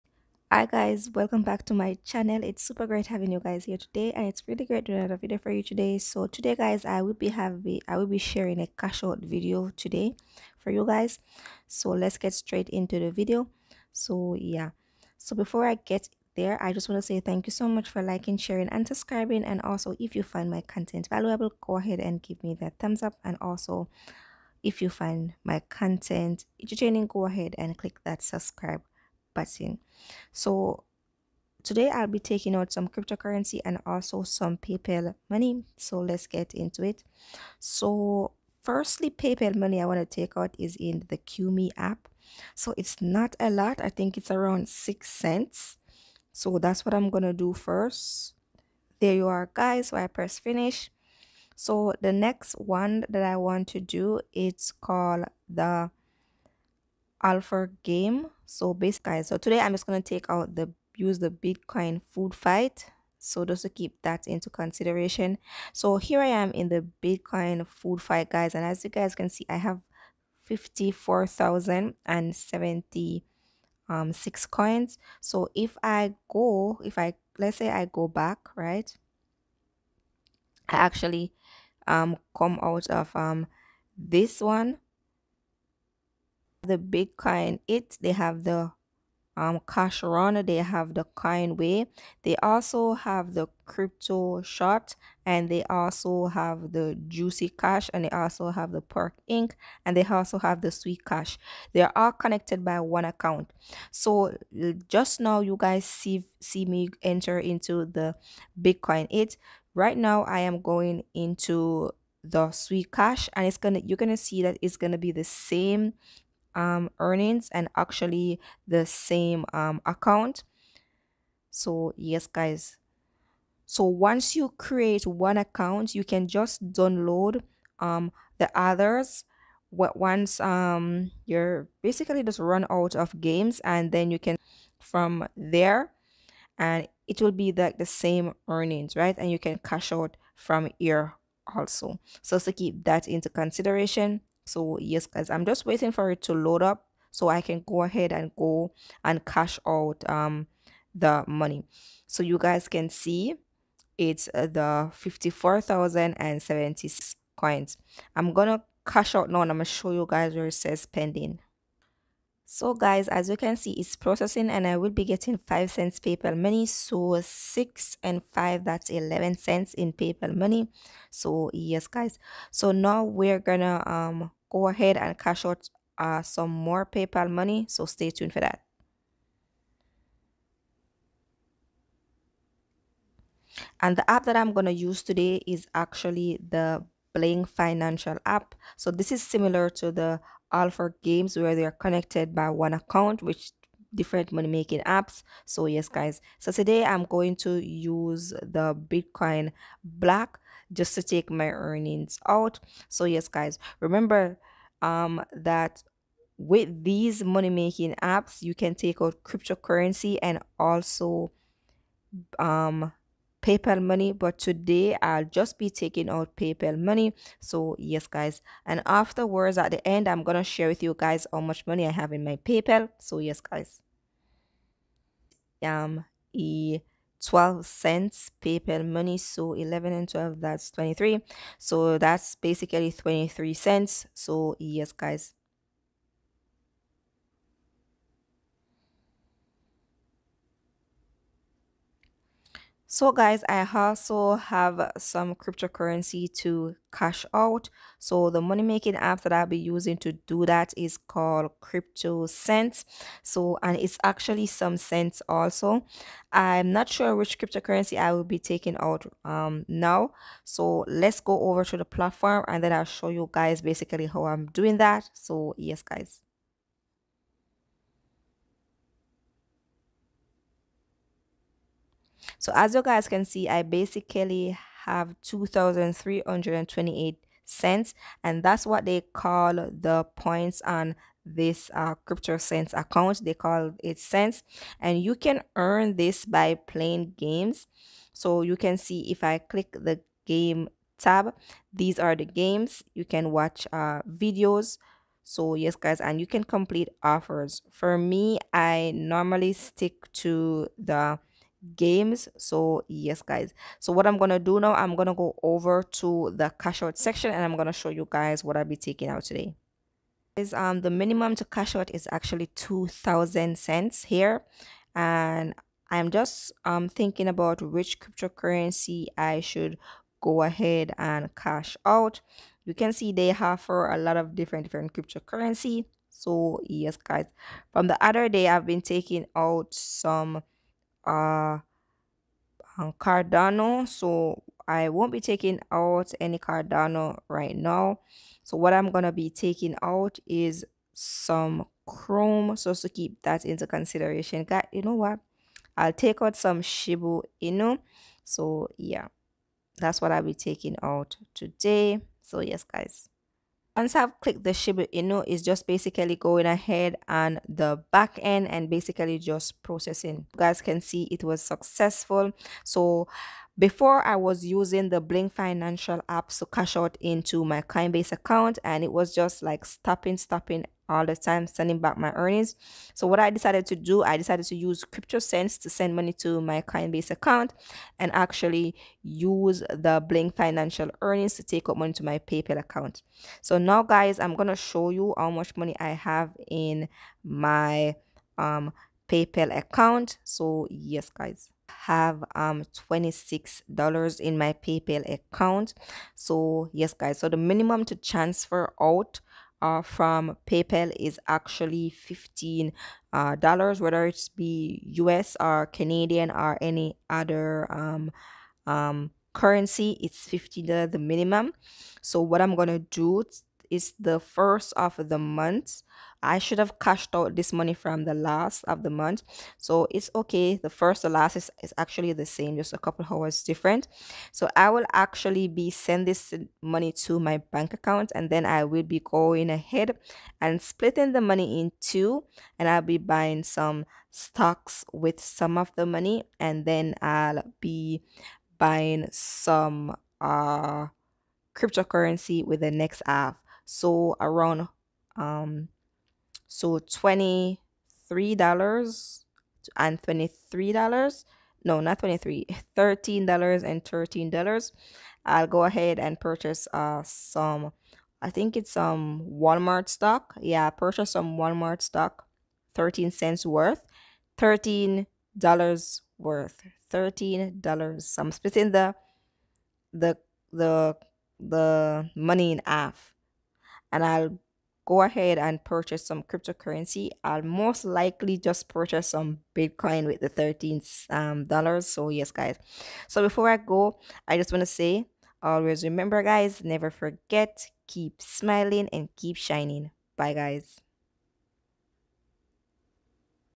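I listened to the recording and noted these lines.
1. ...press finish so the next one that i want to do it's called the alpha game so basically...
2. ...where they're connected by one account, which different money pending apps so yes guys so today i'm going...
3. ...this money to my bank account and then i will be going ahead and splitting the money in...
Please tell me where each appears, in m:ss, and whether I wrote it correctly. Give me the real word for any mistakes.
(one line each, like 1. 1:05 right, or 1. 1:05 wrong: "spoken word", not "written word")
1. 0:50 right
2. 3:11 wrong: "making", not "pending"
3. 7:06 right.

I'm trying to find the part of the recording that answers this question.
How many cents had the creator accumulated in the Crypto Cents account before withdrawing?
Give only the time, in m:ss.
4:35.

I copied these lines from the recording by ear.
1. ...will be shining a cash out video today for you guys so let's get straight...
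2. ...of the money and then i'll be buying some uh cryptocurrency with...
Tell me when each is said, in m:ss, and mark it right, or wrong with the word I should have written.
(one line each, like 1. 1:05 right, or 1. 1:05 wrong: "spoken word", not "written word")
1. 0:07 wrong: "sharing", not "shining"
2. 7:15 right.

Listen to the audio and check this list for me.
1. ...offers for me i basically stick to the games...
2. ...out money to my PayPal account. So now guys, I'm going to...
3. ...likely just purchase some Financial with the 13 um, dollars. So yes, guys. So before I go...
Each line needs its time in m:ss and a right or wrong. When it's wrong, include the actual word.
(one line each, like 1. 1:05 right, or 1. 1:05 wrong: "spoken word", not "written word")
1. 4:57 wrong: "normally", not "basically"
2. 6:21 right
3. 7:57 wrong: "Bitcoin", not "Financial".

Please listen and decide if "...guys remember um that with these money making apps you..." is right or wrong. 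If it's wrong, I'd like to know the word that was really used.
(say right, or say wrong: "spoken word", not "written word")
right.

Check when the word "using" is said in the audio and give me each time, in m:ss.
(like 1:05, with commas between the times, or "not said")
4:09, 6:04.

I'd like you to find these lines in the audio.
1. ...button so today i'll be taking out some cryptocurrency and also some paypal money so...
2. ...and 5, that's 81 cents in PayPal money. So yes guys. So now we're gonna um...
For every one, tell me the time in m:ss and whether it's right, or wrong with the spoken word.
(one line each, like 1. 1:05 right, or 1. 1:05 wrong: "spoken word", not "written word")
1. 0:29 right
2. 2:48 wrong: "11", not "81".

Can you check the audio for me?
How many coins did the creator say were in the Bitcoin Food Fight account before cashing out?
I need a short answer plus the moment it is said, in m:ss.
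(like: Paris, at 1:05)
54,076, at 2:34.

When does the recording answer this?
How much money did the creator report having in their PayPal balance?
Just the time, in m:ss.
6:32.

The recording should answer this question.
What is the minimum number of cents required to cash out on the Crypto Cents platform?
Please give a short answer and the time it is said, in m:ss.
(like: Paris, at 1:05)
2,000, at 5:12.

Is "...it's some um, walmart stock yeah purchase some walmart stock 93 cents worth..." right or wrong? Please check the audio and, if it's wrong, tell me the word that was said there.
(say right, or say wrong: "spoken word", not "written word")
wrong: "13", not "93".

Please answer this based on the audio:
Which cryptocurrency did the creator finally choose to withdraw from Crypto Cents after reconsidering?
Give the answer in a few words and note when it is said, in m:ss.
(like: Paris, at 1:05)
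Shiba Inu, at 5:46.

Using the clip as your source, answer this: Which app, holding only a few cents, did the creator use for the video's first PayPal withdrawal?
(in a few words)
Qmee.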